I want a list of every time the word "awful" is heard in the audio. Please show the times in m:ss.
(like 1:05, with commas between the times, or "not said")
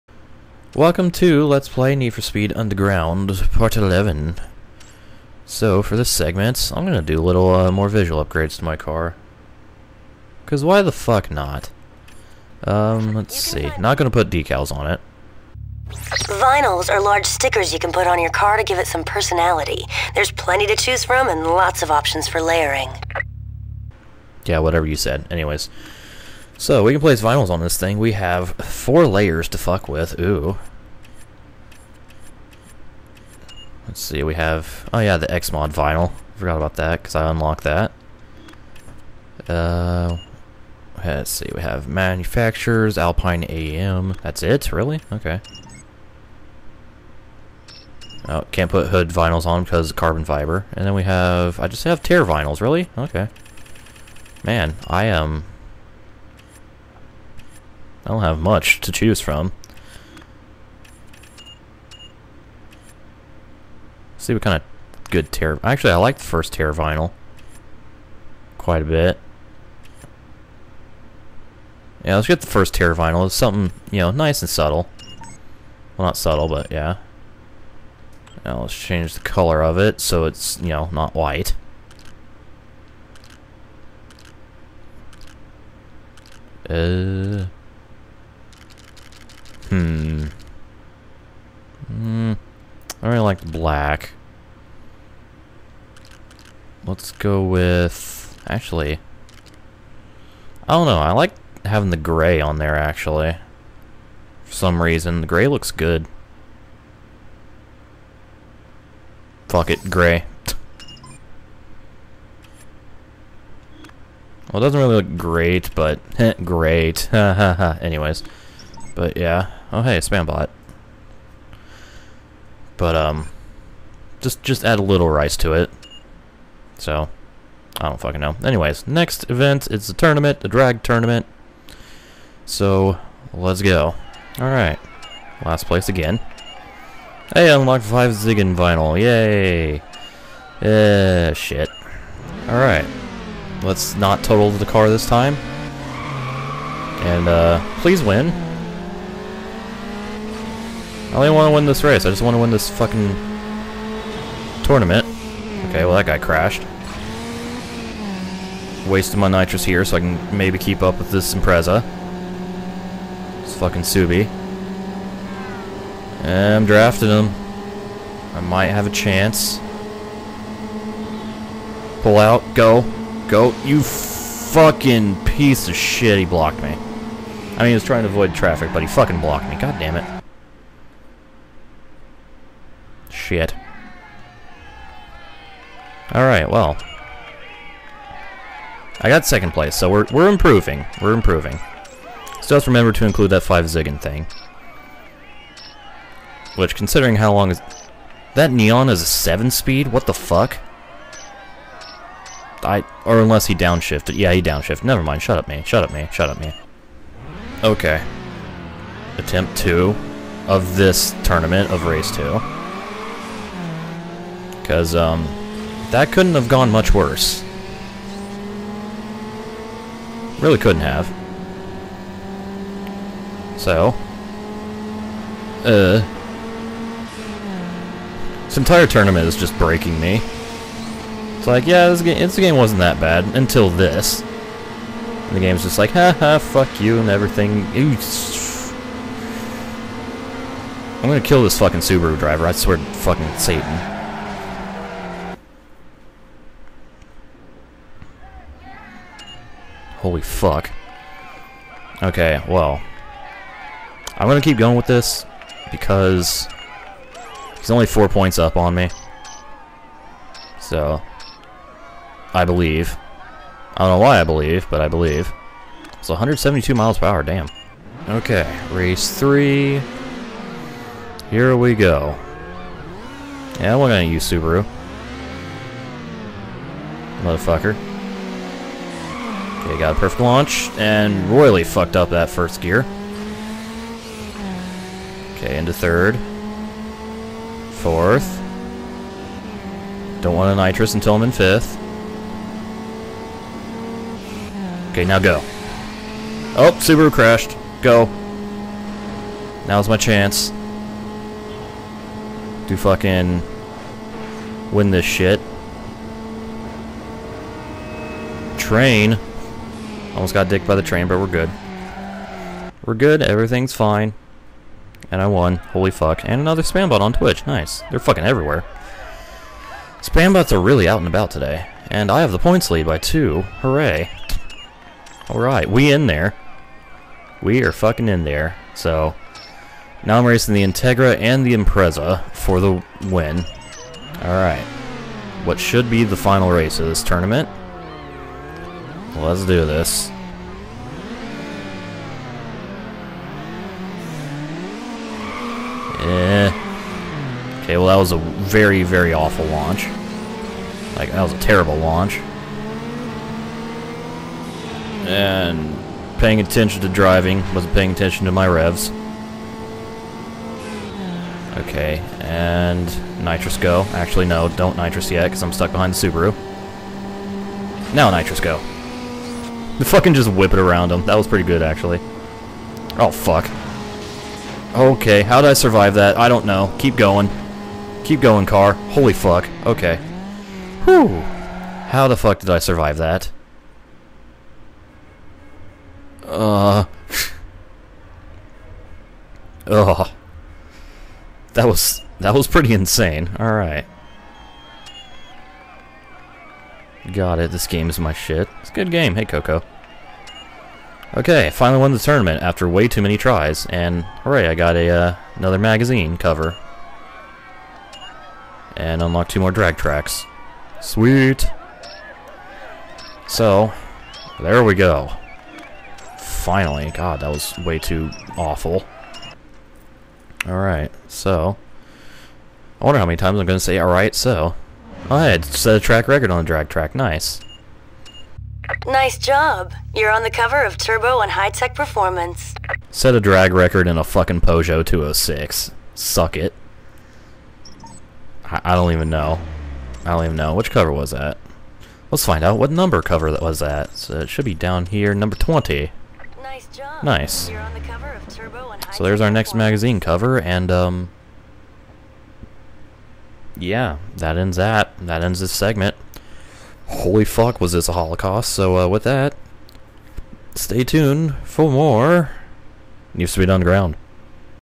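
5:49, 6:58.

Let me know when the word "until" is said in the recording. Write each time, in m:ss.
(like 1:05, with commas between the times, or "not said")
3:53, 4:50.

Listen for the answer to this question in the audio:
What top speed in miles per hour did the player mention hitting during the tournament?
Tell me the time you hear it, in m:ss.
4:26.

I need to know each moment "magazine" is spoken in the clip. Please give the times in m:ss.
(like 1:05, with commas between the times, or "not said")
6:45, 7:29.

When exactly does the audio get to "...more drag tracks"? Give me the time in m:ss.
6:49.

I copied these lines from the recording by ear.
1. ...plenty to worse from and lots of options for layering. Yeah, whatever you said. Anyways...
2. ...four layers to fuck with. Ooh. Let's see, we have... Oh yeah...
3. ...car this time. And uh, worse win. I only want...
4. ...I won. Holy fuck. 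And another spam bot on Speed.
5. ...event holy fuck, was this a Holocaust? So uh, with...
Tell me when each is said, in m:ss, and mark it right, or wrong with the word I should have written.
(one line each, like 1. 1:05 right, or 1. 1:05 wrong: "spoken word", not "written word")
1. 0:20 wrong: "choose", not "worse"
2. 0:28 right
3. 2:24 wrong: "please", not "worse"
4. 5:15 wrong: "Twitch", not "Speed"
5. 7:35 wrong: "segment", not "event".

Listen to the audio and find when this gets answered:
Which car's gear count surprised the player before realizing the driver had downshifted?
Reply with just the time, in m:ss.
3:18.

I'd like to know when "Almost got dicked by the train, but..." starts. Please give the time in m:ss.
5:10.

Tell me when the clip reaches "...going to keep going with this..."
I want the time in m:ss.
4:14.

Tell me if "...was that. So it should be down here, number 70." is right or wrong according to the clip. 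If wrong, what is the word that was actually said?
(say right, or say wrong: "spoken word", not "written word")
wrong: "20", not "70".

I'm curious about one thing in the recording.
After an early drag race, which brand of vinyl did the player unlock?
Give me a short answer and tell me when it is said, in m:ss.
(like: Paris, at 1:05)
5 Zigen, at 2:17.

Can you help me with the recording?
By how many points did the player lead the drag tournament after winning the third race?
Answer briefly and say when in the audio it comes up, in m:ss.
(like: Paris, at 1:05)
2, at 5:22.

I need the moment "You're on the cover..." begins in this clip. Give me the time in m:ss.
7:09.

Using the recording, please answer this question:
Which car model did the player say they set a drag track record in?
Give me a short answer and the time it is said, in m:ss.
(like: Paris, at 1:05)
Peugeot 206, at 7:14.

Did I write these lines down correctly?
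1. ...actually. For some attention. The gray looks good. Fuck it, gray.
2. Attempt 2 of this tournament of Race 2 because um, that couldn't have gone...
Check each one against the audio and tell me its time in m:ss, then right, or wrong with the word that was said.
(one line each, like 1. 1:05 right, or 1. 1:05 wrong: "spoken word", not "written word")
1. 1:42 wrong: "reason", not "attention"
2. 3:29 right.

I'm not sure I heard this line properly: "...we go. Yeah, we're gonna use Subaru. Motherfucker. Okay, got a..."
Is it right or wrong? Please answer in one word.
right.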